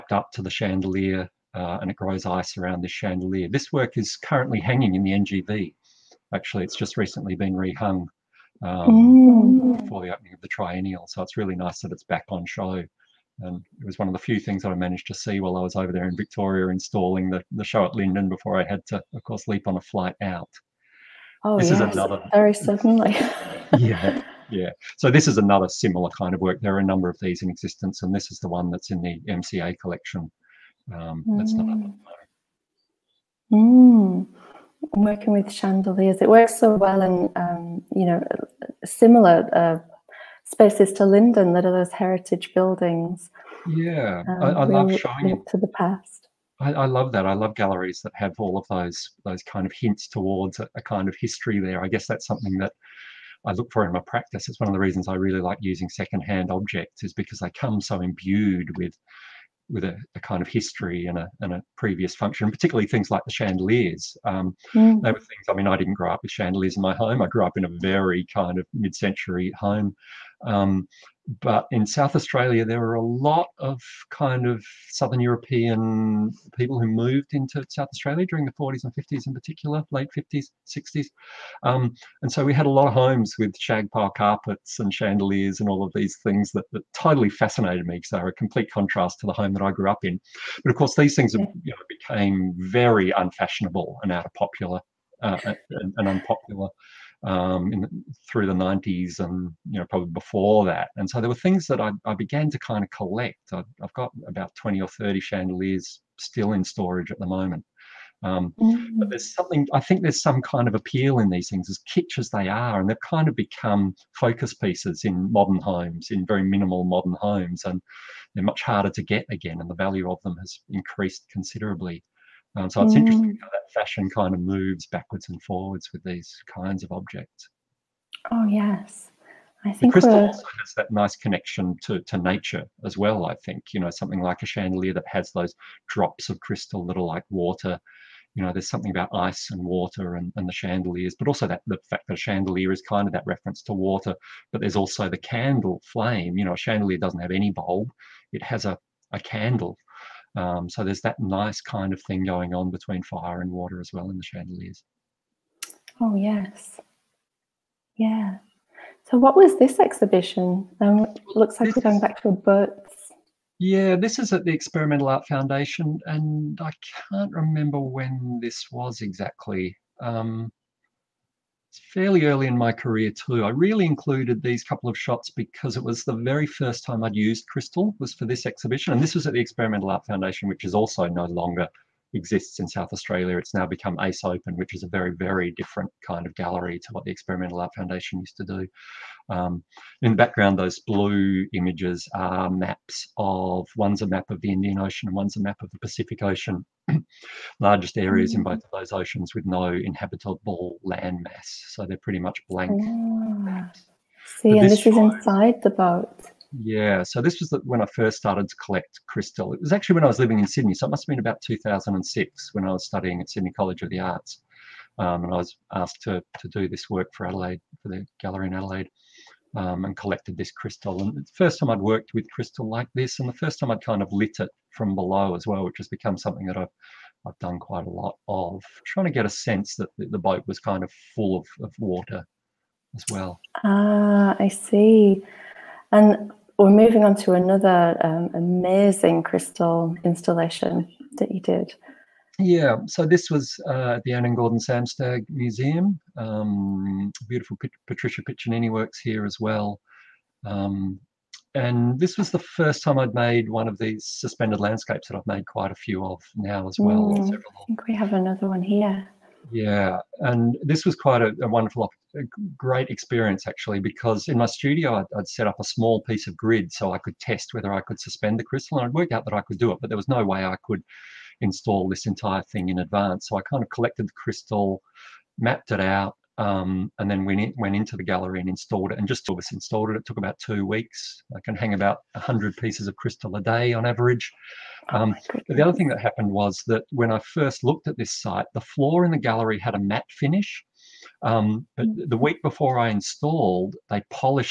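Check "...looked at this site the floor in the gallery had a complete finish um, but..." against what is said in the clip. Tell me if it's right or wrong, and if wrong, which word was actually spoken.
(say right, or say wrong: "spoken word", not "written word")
wrong: "matte", not "complete".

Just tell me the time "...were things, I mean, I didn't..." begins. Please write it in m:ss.
1:05.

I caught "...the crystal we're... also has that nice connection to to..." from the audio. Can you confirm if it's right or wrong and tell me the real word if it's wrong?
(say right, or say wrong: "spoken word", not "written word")
right.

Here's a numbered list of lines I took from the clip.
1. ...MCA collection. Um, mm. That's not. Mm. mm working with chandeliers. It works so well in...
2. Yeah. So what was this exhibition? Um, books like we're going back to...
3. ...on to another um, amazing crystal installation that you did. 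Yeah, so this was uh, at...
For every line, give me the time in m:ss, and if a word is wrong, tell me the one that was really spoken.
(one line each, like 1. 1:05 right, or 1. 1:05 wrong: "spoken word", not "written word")
1. 0:29 right
2. 2:37 wrong: "looks", not "books"
3. 3:57 right.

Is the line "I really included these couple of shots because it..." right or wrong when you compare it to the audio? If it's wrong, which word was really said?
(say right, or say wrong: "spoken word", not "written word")
right.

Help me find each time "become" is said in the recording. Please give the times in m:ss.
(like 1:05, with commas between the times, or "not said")
1:53, 3:03, 3:45.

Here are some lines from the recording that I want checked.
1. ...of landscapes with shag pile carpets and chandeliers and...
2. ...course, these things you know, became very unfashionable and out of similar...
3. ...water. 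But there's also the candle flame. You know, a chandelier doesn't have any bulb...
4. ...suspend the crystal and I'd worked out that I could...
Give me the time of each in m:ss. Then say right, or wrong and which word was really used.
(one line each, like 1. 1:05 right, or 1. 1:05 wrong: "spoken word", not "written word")
1. 1:22 wrong: "homes", not "landscapes"
2. 1:30 wrong: "popular", not "similar"
3. 2:23 right
4. 4:28 right.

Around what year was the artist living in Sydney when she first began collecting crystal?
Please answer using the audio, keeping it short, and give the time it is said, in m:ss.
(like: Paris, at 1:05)
2006, at 3:31.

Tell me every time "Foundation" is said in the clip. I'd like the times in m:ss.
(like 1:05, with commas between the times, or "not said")
2:45, 3:00, 3:07.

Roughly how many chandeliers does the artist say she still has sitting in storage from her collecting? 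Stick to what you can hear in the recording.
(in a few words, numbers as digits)
20 or 30.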